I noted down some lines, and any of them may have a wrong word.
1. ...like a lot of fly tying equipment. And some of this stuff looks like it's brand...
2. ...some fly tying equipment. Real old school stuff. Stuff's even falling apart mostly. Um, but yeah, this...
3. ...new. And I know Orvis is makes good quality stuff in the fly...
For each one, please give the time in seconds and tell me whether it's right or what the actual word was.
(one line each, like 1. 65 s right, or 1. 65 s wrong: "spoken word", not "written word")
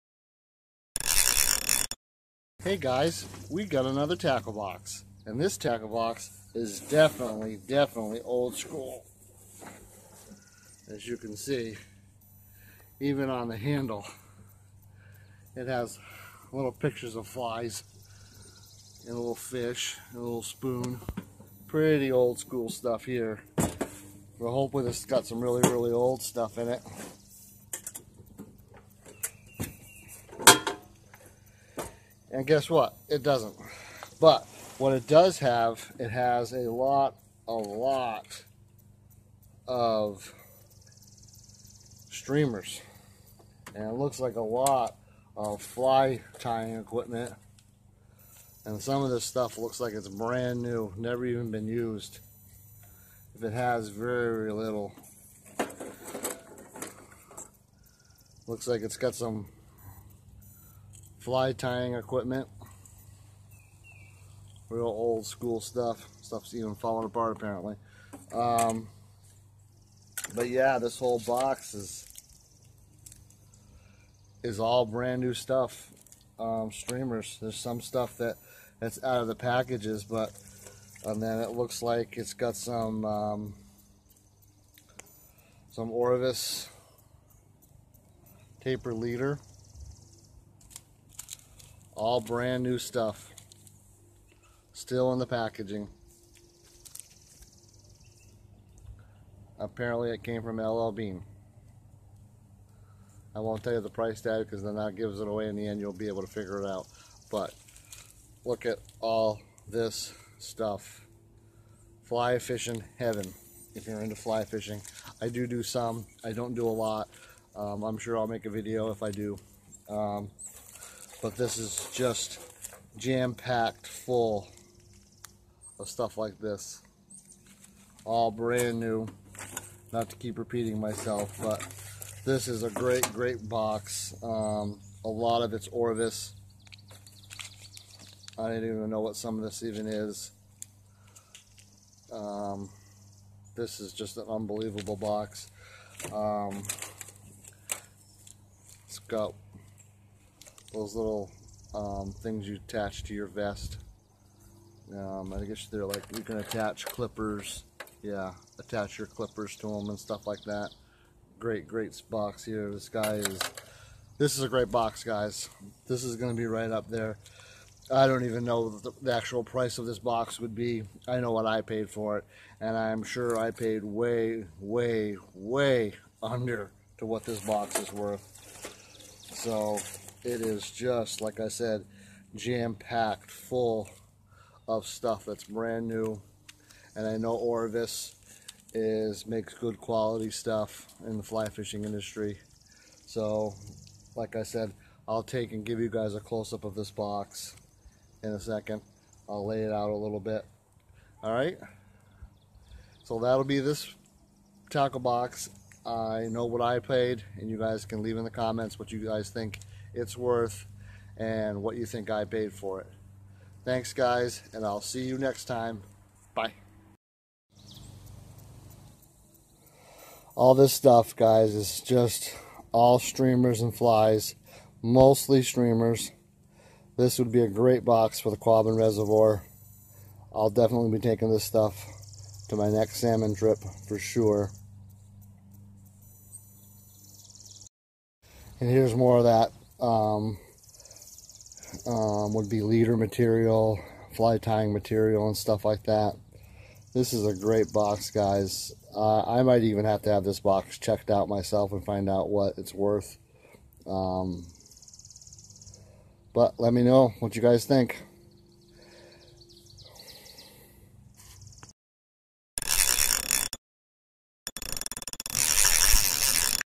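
1. 44 s right
2. 59 s wrong: "apparently", not "mostly"
3. 185 s right.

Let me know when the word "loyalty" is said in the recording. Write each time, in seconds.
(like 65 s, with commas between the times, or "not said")
not said.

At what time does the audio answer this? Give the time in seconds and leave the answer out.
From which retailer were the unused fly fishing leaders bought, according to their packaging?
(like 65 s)
100 s.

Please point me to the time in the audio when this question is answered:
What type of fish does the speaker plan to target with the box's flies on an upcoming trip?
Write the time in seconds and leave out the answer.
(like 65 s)
232 s.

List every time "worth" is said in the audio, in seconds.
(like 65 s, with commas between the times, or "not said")
177 s, 210 s, 252 s.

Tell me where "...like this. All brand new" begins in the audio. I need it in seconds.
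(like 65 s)
126 s.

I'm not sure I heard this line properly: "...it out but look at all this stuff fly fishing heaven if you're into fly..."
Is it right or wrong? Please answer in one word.
right.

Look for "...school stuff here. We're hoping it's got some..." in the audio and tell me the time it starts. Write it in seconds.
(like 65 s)
22 s.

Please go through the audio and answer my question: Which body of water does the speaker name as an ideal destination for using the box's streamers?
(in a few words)
Quabbin Reservoir.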